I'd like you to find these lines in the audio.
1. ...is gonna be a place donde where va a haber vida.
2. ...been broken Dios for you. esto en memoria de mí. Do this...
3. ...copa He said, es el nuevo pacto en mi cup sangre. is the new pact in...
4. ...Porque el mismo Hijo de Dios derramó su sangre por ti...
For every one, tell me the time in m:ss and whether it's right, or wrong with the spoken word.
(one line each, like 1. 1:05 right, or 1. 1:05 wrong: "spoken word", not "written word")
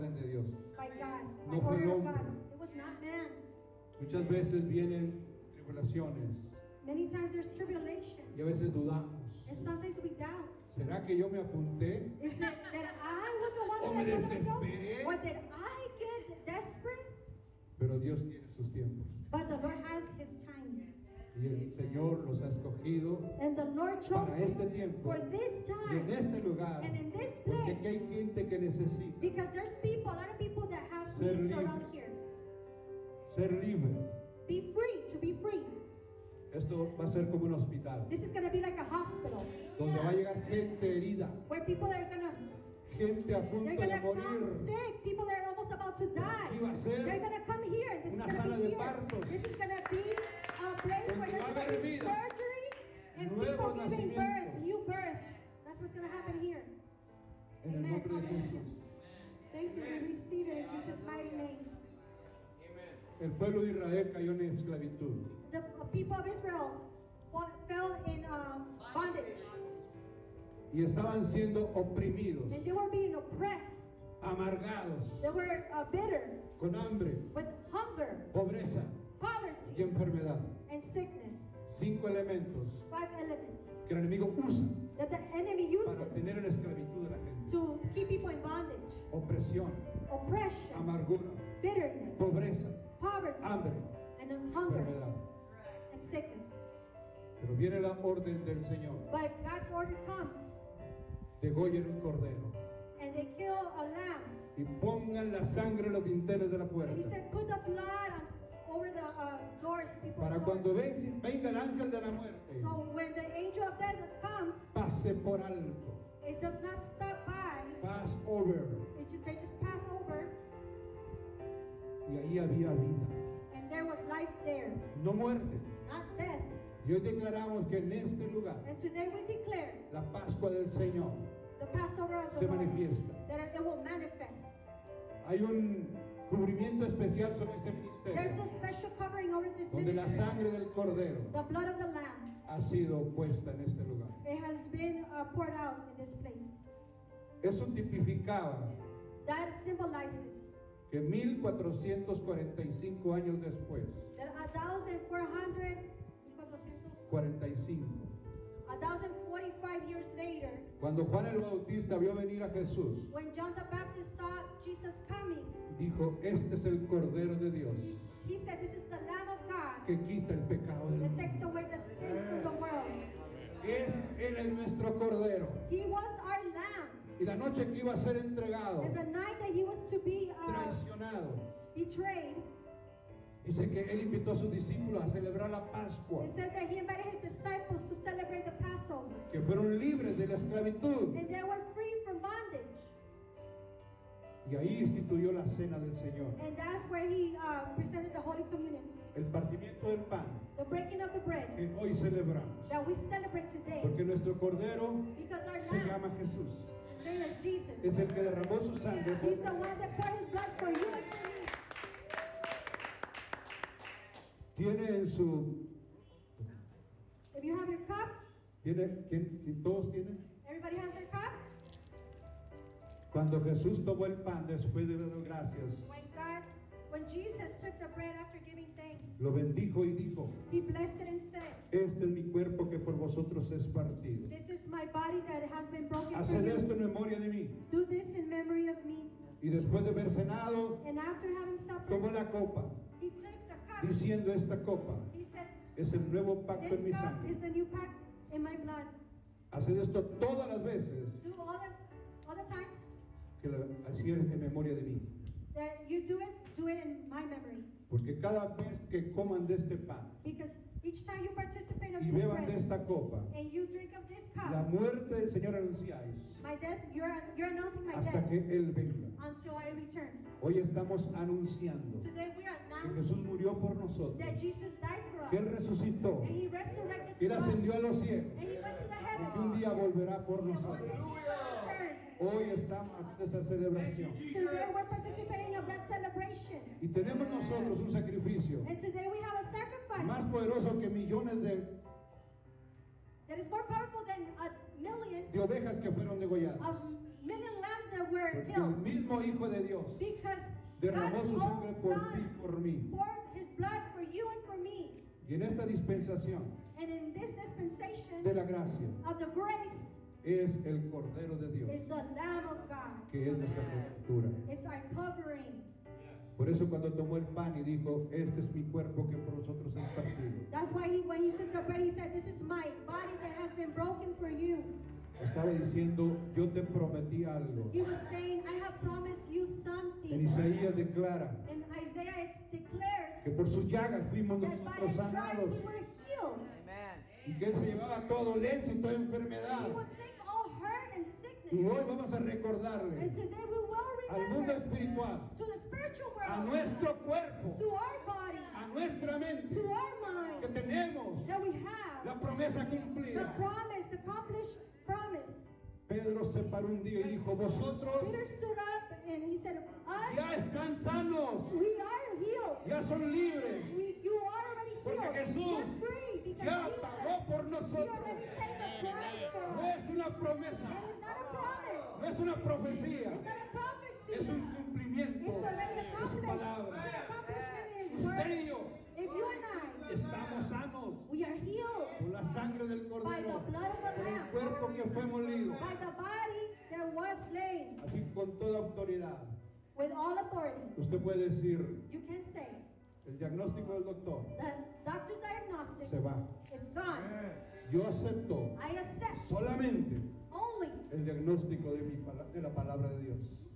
1. 0:49 right
2. 3:55 wrong: "Haced", not "Dios"
3. 4:04 right
4. 4:58 right.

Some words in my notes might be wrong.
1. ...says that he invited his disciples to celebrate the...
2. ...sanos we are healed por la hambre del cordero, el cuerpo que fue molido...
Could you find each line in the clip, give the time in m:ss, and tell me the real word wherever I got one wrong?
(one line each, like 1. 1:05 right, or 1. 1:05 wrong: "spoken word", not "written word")
1. 3:06 right
2. 6:20 wrong: "sangre", not "hambre".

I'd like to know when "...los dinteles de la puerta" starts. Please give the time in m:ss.
1:45.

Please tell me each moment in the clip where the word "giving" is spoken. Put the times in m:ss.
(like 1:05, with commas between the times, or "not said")
0:53, 3:48.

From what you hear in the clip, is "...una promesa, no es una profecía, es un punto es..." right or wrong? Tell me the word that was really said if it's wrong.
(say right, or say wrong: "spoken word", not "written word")
wrong: "cumplimiento", not "punto".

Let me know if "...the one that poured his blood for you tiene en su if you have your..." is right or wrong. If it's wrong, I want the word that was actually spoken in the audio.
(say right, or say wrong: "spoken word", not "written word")
right.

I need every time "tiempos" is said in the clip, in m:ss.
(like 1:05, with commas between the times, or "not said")
0:18, 0:24.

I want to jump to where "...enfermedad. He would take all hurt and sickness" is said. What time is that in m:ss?
5:38.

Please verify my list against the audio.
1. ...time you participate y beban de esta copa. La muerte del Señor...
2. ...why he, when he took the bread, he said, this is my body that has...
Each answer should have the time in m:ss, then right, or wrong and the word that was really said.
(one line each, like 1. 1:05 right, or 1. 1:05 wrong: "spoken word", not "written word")
1. 4:21 right
2. 5:20 right.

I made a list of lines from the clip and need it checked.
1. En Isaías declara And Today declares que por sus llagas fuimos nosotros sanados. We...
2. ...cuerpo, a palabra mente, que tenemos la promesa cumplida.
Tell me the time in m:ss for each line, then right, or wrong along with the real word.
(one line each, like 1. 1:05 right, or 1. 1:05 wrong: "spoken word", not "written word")
1. 5:30 wrong: "Isaiah", not "Today"
2. 5:47 wrong: "nuestra", not "palabra".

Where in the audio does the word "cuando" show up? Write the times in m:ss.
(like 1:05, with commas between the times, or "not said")
1:50, 2:40, 3:43, 5:16.